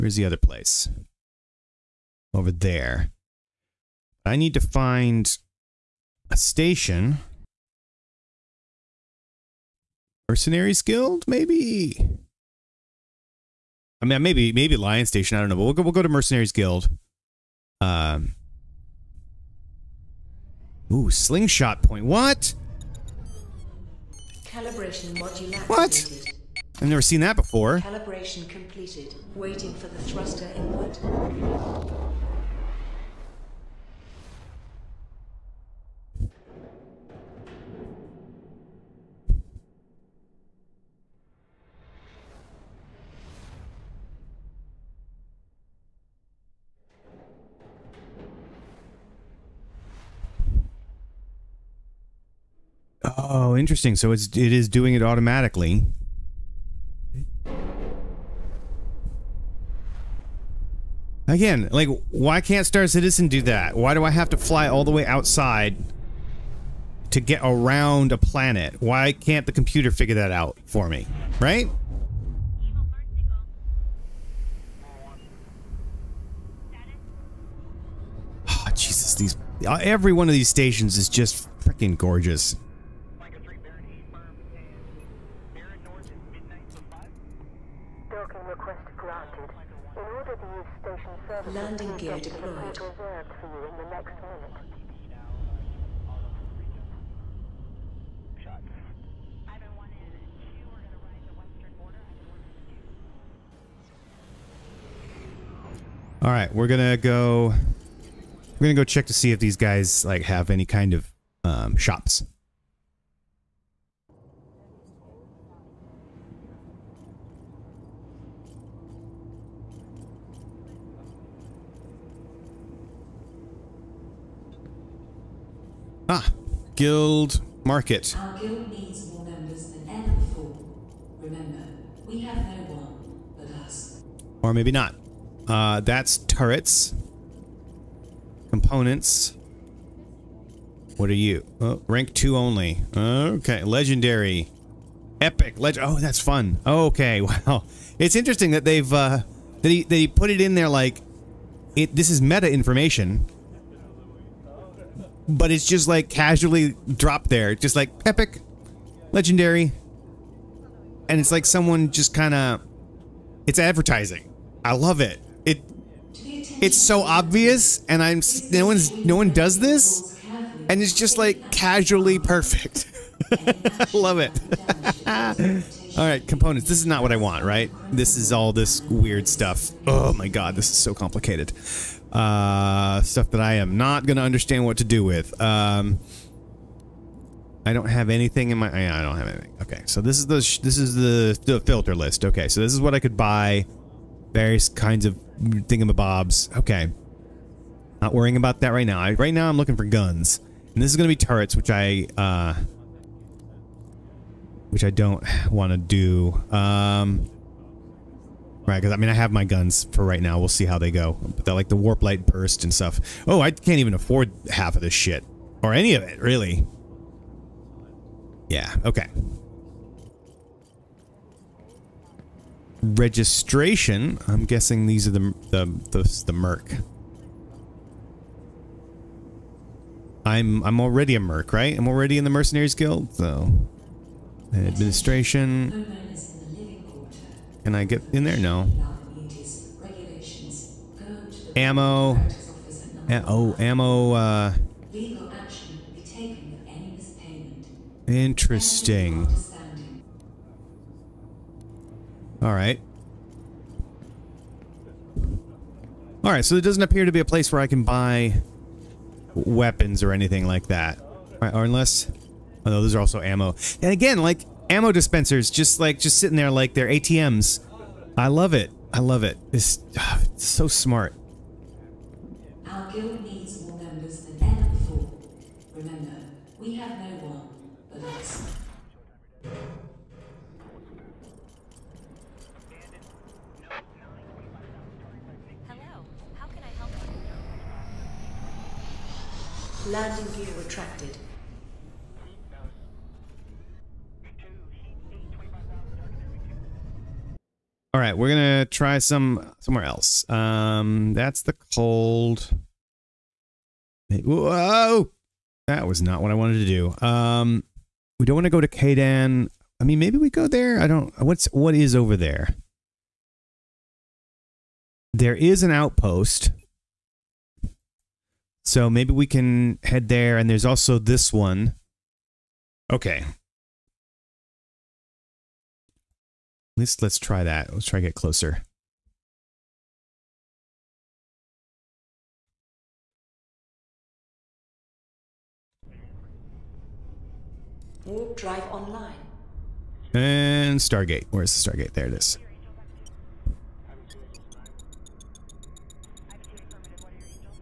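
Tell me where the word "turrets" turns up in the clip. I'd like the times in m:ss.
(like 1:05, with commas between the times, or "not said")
2:16, 3:21.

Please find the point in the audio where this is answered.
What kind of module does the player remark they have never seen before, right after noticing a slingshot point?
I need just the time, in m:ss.
0:24.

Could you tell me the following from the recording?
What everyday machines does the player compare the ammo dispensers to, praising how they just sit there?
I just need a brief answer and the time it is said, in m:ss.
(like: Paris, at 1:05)
ATMs, at 4:26.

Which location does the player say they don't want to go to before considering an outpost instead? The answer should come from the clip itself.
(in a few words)
Kadan.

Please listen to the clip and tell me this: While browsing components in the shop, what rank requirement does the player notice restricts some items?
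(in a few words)
rank 2.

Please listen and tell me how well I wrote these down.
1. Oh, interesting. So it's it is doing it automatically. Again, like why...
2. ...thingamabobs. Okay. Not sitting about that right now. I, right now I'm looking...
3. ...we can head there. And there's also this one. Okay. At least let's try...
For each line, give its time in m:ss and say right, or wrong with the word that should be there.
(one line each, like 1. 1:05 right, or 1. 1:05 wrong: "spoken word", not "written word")
1. 0:53 right
2. 3:15 wrong: "worrying", not "sitting"
3. 5:19 right.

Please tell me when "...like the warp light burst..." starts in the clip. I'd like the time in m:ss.
3:31.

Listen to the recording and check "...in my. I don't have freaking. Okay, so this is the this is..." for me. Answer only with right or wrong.
wrong.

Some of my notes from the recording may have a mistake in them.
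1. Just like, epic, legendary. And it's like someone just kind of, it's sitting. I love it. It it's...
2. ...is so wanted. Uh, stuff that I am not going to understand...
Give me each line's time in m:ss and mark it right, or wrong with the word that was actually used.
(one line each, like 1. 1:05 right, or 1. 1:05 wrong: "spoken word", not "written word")
1. 2:37 wrong: "advertising", not "sitting"
2. 3:00 wrong: "complicated", not "wanted".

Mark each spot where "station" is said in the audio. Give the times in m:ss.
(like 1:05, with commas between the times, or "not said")
0:06, 0:15, 1:20.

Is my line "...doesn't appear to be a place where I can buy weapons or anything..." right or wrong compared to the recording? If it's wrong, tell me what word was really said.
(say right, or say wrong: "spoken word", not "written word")
right.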